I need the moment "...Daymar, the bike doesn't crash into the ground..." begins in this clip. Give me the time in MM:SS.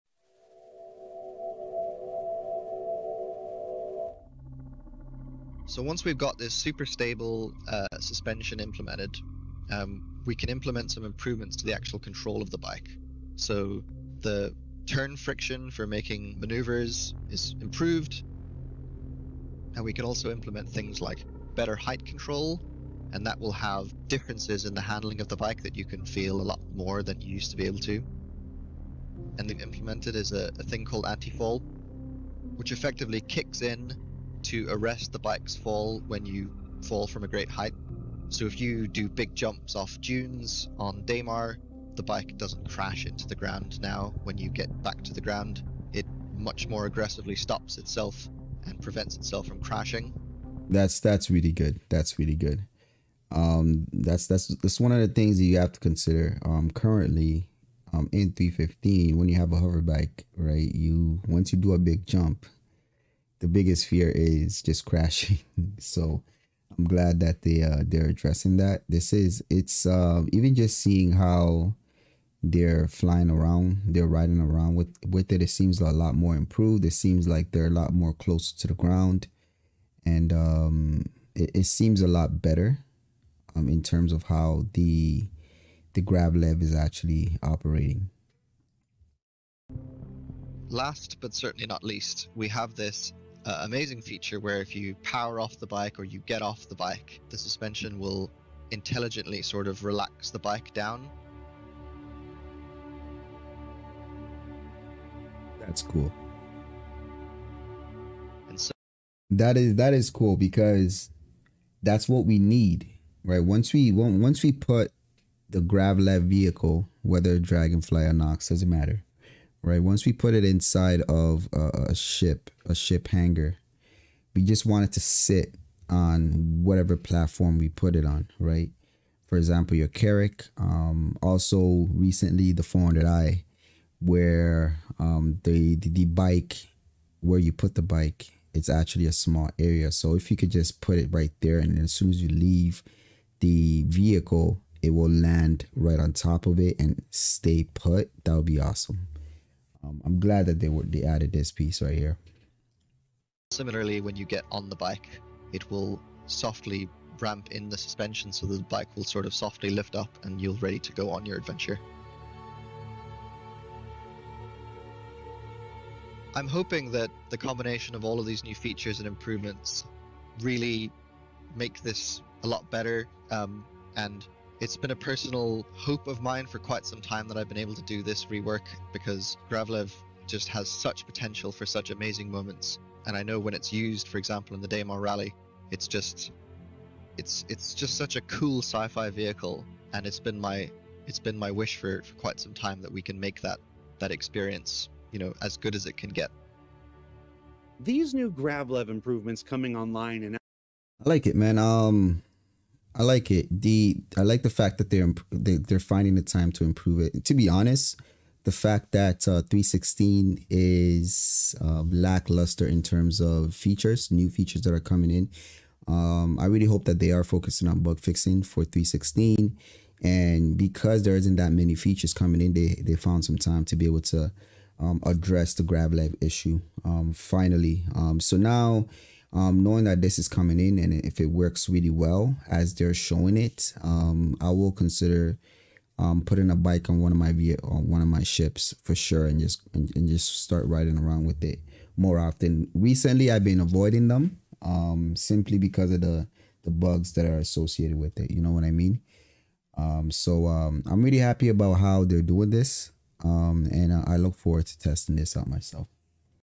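00:41.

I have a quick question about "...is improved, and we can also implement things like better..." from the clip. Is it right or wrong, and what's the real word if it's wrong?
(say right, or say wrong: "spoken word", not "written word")
right.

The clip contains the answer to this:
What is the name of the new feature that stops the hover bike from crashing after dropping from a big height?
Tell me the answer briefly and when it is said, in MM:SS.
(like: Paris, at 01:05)
Anti-fall, at 00:31.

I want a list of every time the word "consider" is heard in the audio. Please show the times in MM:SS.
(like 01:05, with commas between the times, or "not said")
00:55, 03:54.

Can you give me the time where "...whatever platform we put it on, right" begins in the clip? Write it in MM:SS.
02:06.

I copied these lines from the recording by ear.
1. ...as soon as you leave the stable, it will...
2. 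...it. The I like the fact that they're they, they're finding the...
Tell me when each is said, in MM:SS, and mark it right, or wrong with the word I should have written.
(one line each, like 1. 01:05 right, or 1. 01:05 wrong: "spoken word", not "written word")
1. 02:21 wrong: "vehicle", not "stable"
2. 03:23 right.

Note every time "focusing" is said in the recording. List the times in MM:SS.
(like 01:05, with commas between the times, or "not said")
03:37.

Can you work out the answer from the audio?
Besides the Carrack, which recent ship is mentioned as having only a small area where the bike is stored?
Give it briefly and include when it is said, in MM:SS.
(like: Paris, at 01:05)
400i, at 02:12.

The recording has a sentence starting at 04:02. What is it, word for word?
Recently, I've been avoiding them um, simply because of the the bugs that are associated with it.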